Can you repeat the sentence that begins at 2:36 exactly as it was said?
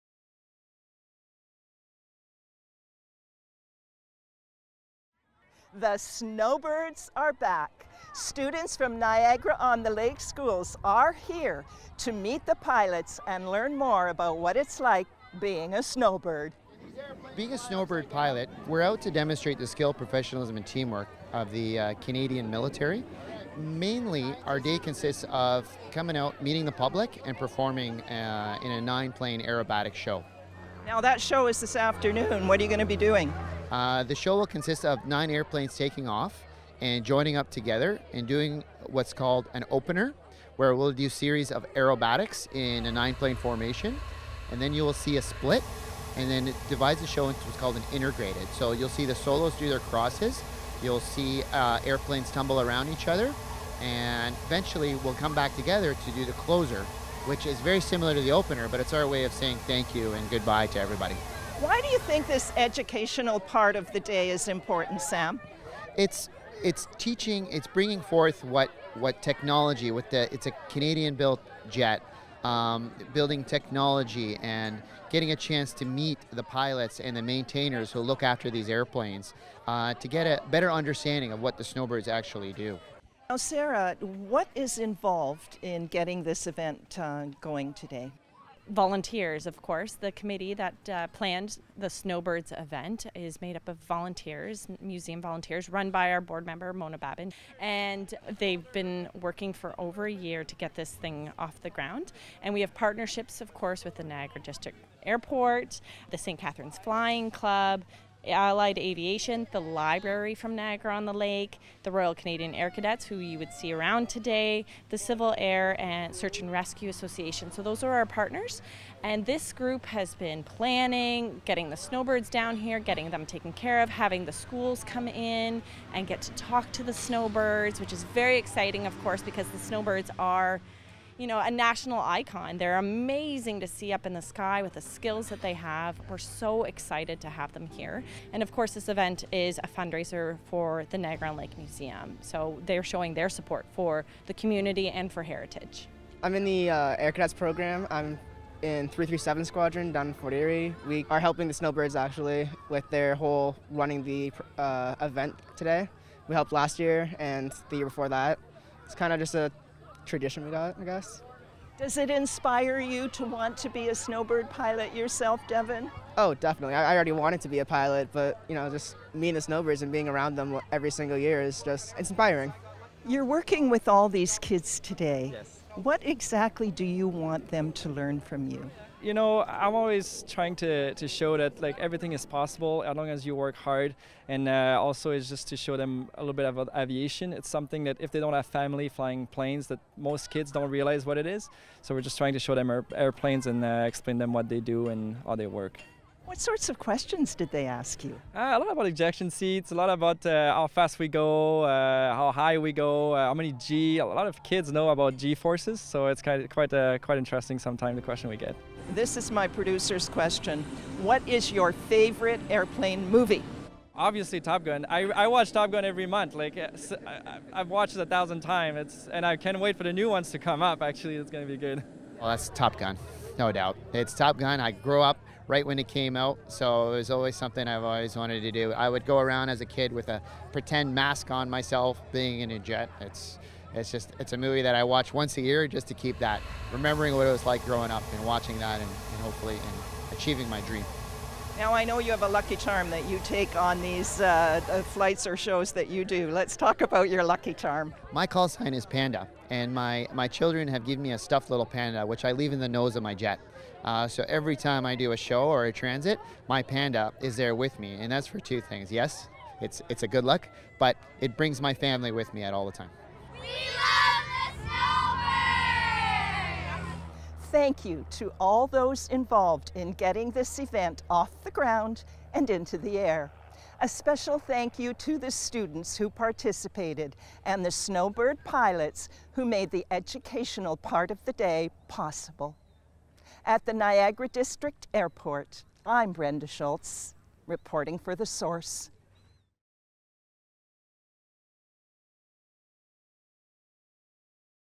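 We helped last year and the year before that.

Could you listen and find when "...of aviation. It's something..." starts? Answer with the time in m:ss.
3:06.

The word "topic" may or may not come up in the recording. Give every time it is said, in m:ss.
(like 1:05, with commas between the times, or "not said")
not said.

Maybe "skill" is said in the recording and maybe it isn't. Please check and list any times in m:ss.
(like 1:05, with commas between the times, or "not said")
0:19, 2:14.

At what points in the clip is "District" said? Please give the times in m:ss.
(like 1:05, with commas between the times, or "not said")
1:44, 4:44.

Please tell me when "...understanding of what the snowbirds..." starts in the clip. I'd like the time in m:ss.
1:20.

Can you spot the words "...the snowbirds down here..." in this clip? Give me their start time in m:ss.
2:01.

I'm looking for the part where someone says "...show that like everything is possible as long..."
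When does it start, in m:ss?
3:01.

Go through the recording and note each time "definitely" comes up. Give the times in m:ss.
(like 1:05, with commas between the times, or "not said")
2:46.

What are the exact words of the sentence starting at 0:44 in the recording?
And then you will see a split, and then it divides the show into what's called an integrated.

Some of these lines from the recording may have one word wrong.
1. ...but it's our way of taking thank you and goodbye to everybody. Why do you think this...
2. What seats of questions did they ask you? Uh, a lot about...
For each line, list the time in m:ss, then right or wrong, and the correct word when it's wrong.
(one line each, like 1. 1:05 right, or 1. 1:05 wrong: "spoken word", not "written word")
1. 0:58 wrong: "saying", not "taking"
2. 3:16 wrong: "sorts", not "seats".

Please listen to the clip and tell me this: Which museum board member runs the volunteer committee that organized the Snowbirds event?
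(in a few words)
Mona Babin.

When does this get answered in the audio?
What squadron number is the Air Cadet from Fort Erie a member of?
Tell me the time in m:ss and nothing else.
2:28.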